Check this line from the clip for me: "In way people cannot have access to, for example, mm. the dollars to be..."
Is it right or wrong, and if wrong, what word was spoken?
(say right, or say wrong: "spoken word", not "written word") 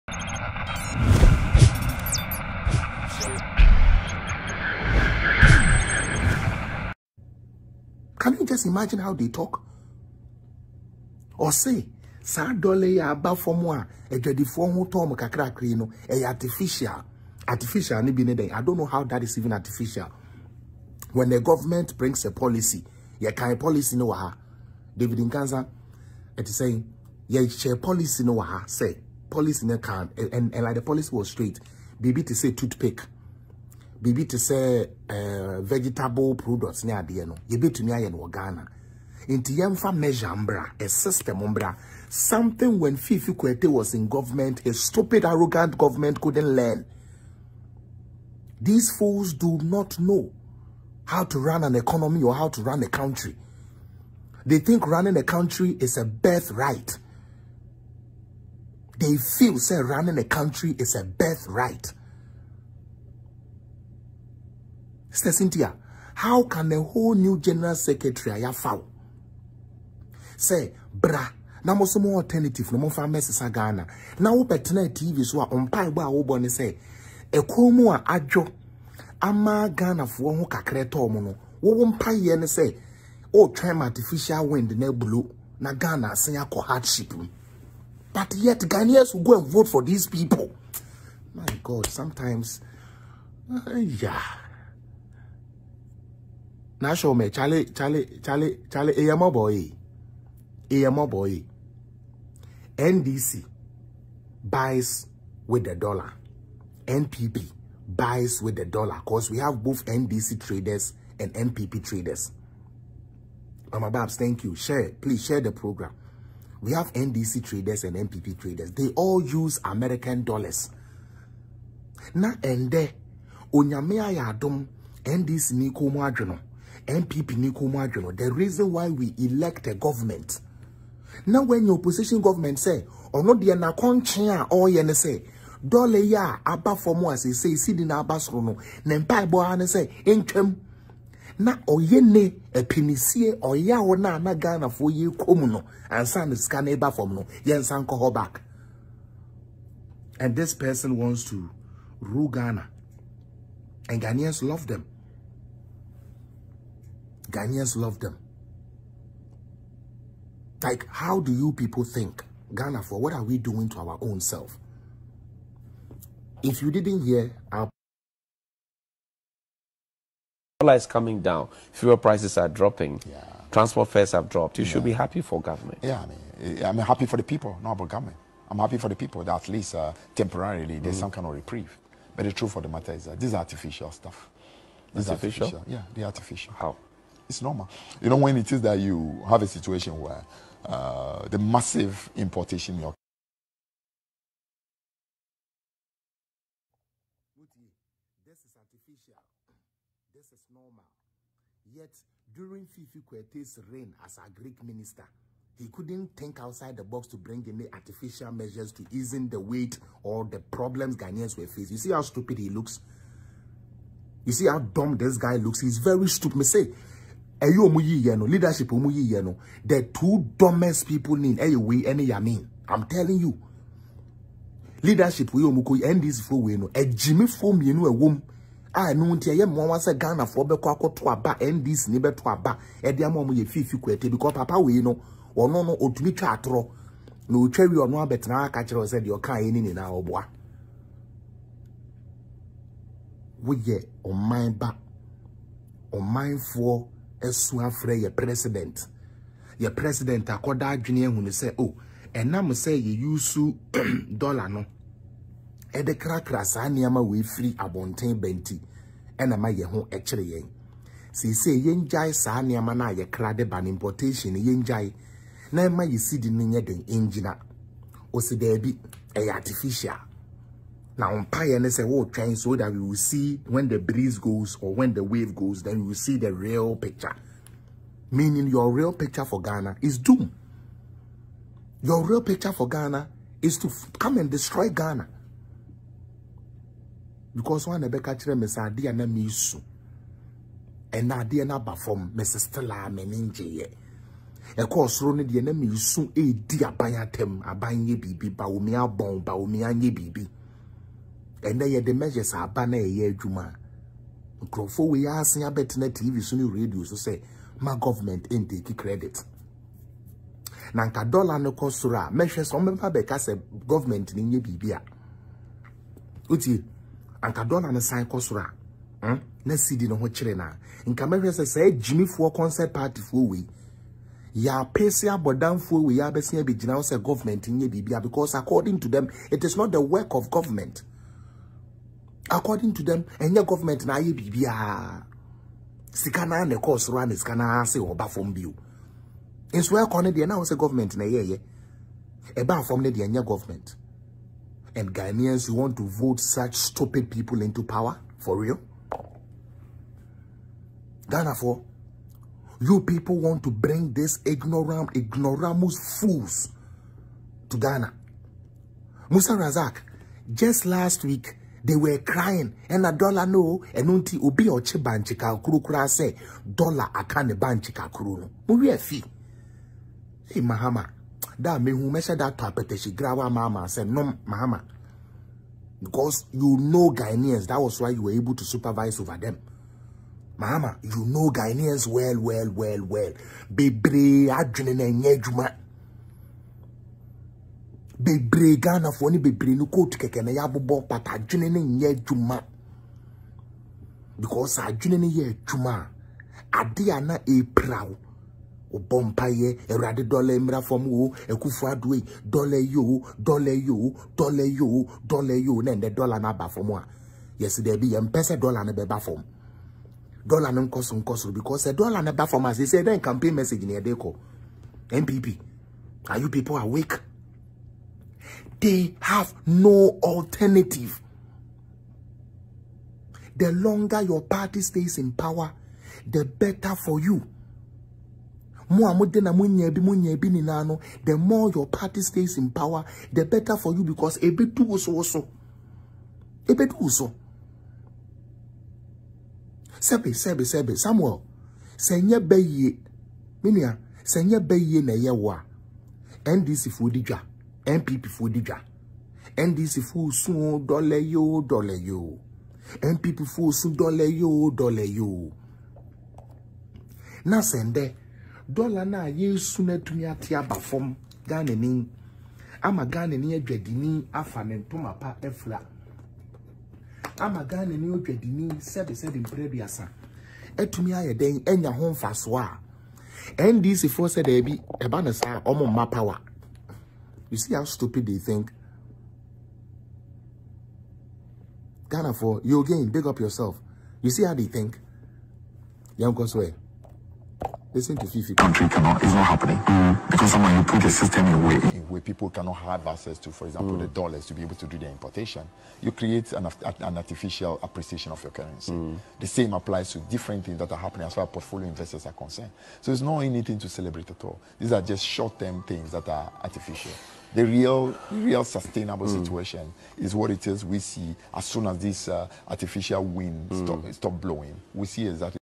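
right.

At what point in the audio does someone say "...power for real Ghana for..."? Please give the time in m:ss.
5:47.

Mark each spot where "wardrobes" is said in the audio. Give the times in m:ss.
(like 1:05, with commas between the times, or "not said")
not said.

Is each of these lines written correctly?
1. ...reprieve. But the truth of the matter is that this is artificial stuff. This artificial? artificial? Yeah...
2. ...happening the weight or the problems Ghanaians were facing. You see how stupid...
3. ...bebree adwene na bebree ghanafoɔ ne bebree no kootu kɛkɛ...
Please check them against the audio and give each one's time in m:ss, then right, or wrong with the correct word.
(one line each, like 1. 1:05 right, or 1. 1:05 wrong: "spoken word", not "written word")
1. 3:01 right
2. 3:28 wrong: "easing", not "happening"
3. 6:23 right.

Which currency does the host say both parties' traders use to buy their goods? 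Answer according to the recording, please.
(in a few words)
American dollars.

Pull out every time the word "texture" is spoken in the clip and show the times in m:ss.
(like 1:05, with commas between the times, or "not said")
not said.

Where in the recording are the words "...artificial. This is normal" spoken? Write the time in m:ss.
3:18.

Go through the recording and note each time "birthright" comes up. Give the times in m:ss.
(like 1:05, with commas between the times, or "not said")
0:56, 1:01.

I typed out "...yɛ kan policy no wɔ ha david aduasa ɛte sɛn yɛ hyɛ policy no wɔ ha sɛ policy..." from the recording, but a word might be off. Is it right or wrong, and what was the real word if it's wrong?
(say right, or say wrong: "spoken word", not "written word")
wrong: "nkansa", not "aduasa".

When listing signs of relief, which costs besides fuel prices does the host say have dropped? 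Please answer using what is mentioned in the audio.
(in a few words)
transport fares.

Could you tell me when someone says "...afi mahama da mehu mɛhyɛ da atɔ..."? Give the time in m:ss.
6:08.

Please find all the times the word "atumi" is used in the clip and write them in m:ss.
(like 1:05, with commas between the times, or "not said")
7:39, 7:50.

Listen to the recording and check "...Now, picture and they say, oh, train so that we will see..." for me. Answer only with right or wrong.
wrong.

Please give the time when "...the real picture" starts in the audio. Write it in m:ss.
4:36.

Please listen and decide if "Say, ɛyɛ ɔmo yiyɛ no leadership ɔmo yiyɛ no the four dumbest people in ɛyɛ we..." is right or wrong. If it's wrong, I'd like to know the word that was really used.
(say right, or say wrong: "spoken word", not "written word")
wrong: "two", not "four".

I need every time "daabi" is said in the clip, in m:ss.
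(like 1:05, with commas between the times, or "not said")
4:28, 7:54.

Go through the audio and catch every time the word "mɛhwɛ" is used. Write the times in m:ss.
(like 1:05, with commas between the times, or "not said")
5:12, 5:21.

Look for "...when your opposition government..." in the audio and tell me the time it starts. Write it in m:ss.
2:11.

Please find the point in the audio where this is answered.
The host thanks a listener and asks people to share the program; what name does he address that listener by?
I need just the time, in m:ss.
1:53.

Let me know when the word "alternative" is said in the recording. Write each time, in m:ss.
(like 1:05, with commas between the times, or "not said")
1:12, 7:00.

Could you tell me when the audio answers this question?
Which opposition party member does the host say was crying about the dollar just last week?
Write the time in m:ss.
5:59.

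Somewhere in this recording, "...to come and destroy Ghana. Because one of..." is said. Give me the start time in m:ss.
4:43.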